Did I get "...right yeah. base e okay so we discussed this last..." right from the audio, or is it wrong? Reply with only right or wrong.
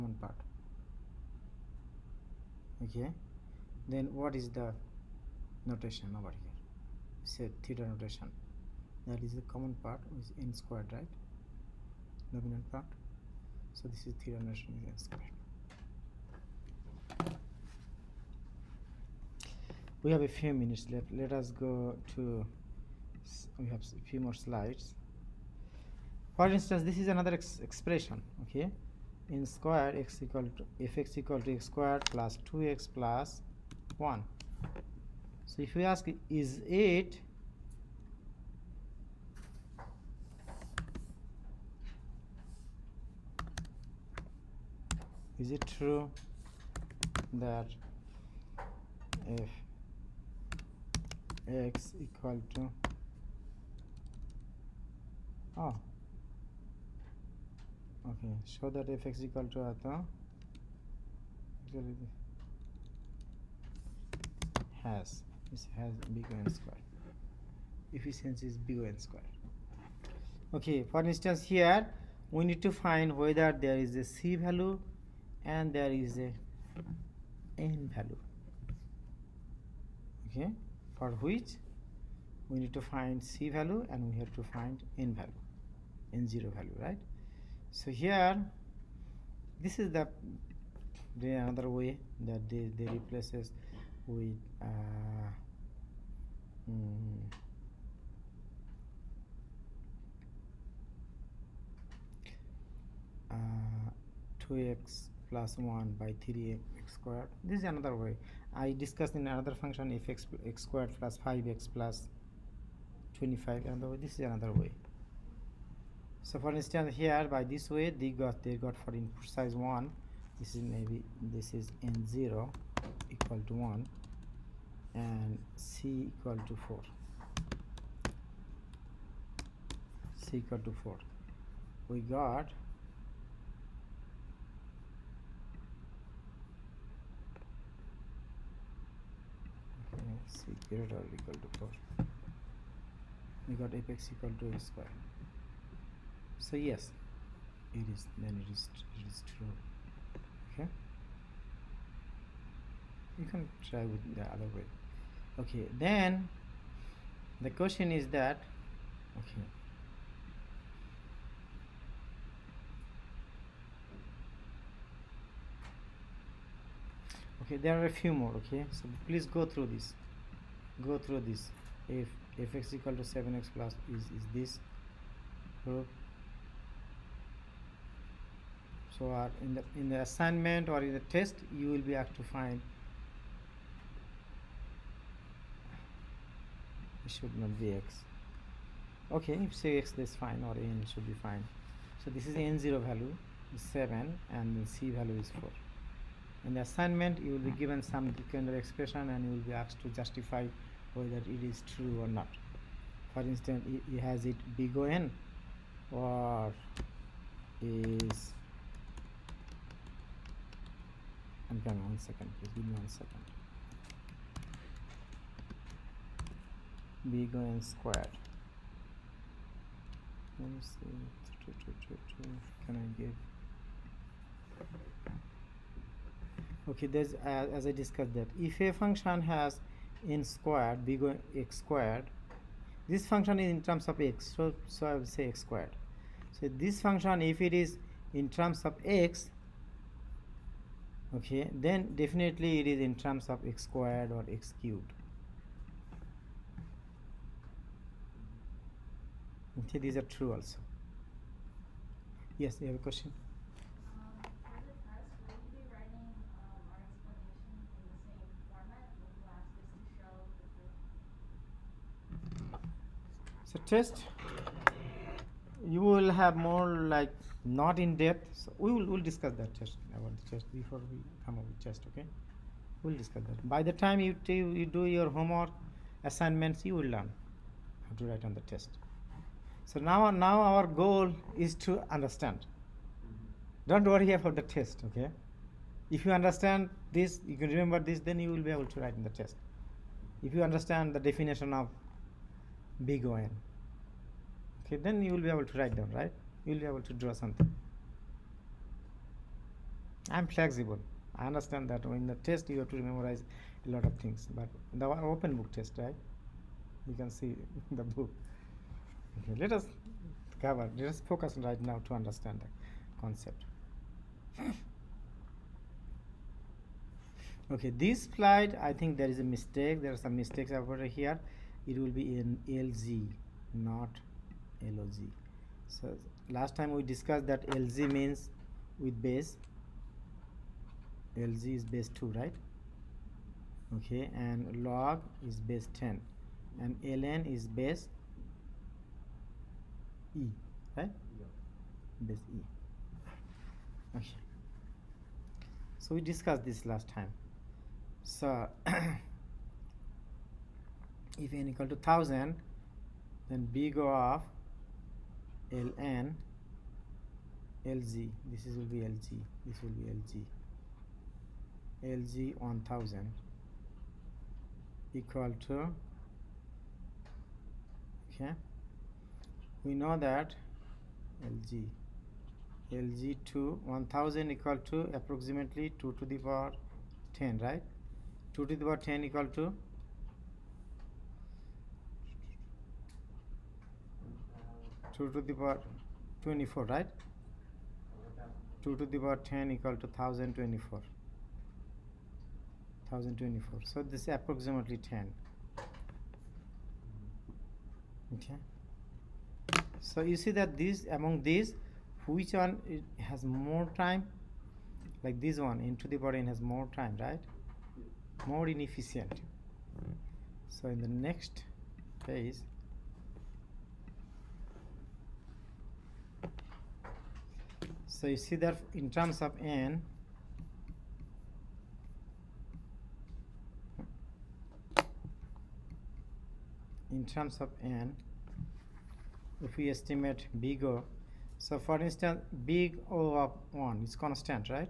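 right.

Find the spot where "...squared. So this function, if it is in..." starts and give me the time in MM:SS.
03:55.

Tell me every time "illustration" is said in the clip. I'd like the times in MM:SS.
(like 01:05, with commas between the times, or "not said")
not said.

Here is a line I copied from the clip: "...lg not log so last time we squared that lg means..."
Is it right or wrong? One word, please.
wrong.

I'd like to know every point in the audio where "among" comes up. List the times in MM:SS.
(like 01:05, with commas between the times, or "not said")
06:40.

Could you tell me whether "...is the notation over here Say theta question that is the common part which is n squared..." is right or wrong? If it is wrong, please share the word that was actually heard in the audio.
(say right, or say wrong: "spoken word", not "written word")
wrong: "notation", not "question".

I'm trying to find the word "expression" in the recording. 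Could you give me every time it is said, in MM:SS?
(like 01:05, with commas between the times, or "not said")
00:27, 03:18.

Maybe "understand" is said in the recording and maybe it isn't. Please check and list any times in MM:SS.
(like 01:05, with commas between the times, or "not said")
04:41, 04:46, 04:50, 05:01, 05:11.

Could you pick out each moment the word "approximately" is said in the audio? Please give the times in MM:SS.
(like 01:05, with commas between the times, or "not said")
06:14, 06:34.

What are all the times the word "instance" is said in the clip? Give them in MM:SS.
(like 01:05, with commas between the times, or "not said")
00:26, 01:11, 01:56, 03:23, 07:11.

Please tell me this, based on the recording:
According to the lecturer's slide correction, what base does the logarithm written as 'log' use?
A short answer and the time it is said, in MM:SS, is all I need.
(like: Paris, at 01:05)
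10, at 05:34.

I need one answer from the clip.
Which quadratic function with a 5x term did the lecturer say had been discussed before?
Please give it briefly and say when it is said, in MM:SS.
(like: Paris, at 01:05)
x squared plus 5x plus 25, at 01:50.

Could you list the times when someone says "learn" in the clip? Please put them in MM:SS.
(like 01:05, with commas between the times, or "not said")
04:36.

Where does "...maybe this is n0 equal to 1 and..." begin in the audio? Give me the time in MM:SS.
02:00.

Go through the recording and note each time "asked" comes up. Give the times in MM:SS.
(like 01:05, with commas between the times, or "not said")
03:01, 03:19.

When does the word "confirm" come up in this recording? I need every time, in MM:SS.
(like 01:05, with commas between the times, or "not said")
not said.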